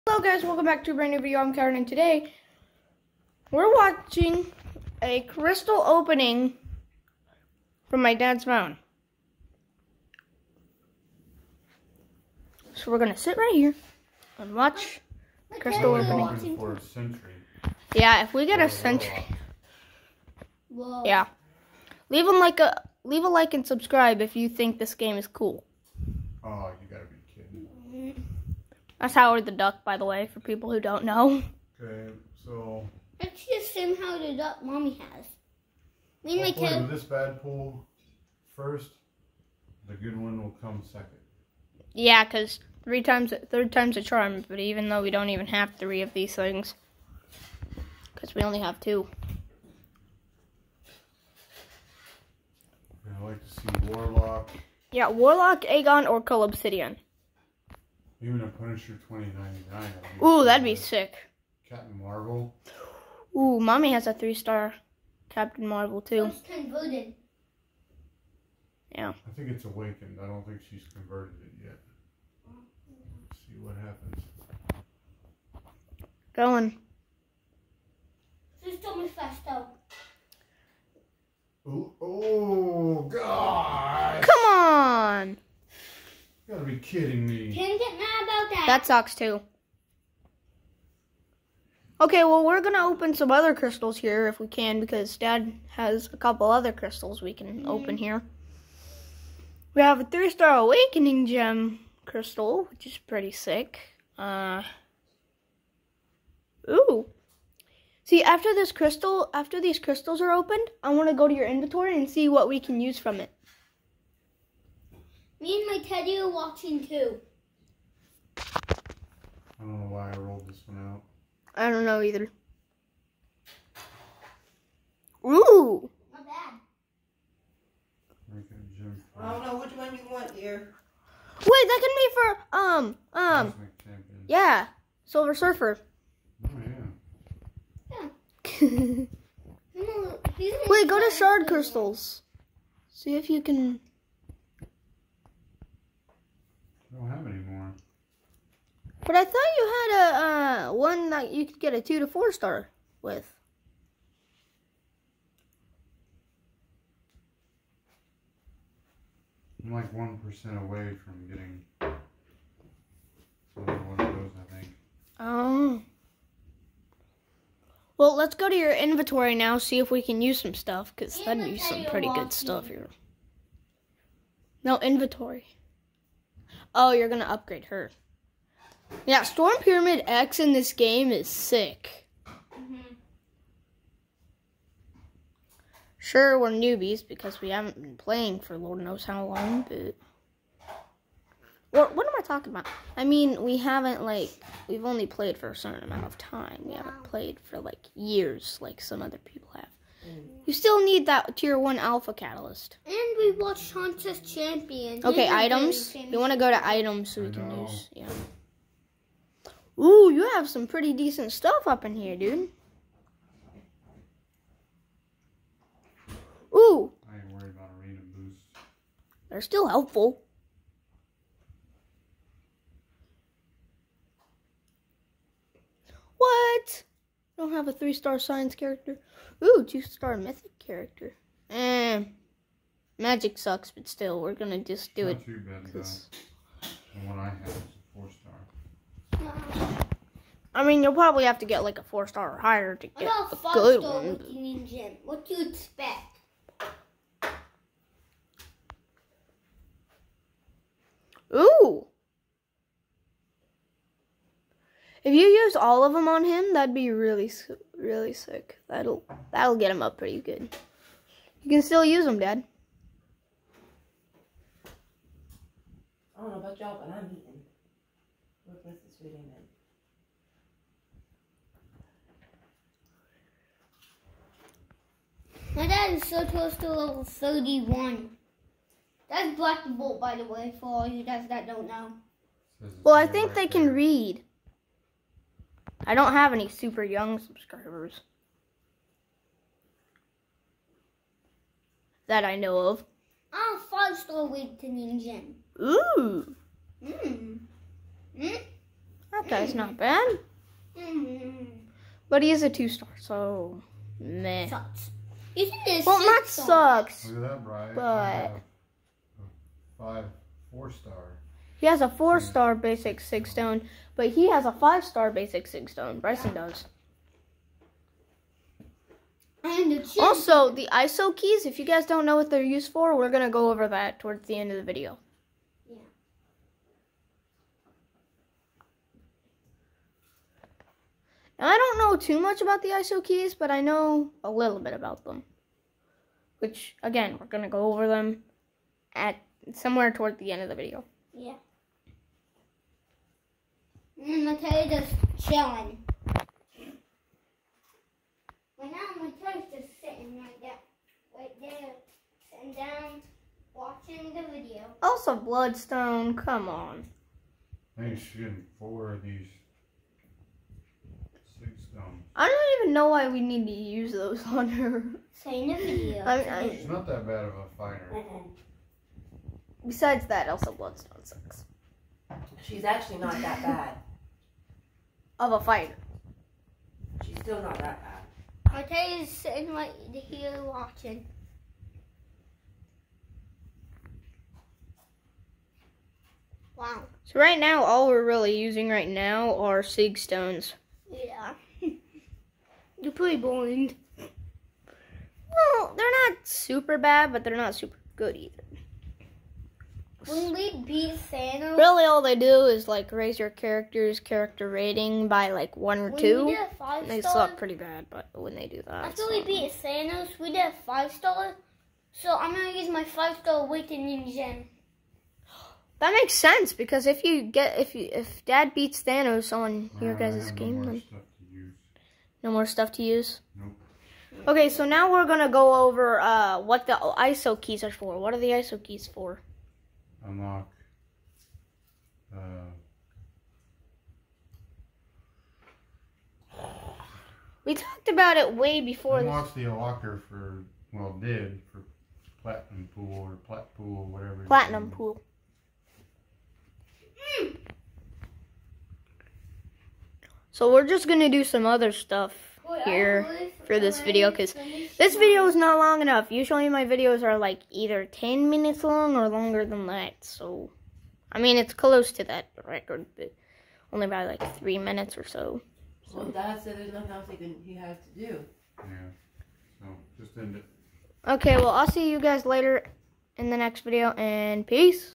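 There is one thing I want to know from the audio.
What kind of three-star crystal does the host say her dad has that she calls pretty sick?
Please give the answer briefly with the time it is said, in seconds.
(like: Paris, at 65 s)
Awakening gem crystal, at 100 s.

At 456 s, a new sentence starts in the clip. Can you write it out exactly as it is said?
Usually my videos are like either 10 minutes long or longer than that.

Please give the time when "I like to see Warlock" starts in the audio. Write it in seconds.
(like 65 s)
53 s.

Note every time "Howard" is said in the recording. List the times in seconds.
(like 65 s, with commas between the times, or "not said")
29 s, 33 s.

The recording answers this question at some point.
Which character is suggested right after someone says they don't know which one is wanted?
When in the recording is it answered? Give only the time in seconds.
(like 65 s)
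135 s.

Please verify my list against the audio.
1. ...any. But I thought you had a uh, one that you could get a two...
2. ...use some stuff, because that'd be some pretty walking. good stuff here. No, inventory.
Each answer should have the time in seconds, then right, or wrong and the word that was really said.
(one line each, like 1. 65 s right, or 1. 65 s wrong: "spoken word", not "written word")
1. 147 s right
2. 170 s right.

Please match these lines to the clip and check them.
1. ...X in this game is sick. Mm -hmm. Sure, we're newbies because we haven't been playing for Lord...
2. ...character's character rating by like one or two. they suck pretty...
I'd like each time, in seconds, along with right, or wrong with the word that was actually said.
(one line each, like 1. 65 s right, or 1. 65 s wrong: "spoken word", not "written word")
1. 180 s right
2. 403 s right.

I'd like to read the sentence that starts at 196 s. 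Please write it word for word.
We haven't played for, like, years like some other people have.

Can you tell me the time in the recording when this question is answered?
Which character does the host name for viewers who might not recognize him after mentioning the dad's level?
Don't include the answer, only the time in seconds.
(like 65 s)
279 s.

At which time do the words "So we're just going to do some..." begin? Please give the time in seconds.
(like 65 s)
450 s.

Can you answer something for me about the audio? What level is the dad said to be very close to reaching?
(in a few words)
31.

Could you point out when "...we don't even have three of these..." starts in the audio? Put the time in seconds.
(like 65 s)
45 s.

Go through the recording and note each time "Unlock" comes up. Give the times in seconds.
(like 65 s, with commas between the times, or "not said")
430 s, 438 s.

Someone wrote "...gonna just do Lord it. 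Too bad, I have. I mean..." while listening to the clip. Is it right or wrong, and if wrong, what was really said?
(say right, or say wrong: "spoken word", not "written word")
wrong: "Not", not "Lord".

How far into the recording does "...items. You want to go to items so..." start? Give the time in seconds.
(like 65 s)
205 s.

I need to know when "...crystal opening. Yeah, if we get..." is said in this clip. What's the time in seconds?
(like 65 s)
15 s.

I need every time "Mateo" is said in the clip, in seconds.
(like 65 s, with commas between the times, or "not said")
344 s, 349 s.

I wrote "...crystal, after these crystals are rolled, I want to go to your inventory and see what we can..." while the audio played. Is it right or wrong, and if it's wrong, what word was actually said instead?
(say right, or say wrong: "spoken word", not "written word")
wrong: "opened", not "rolled".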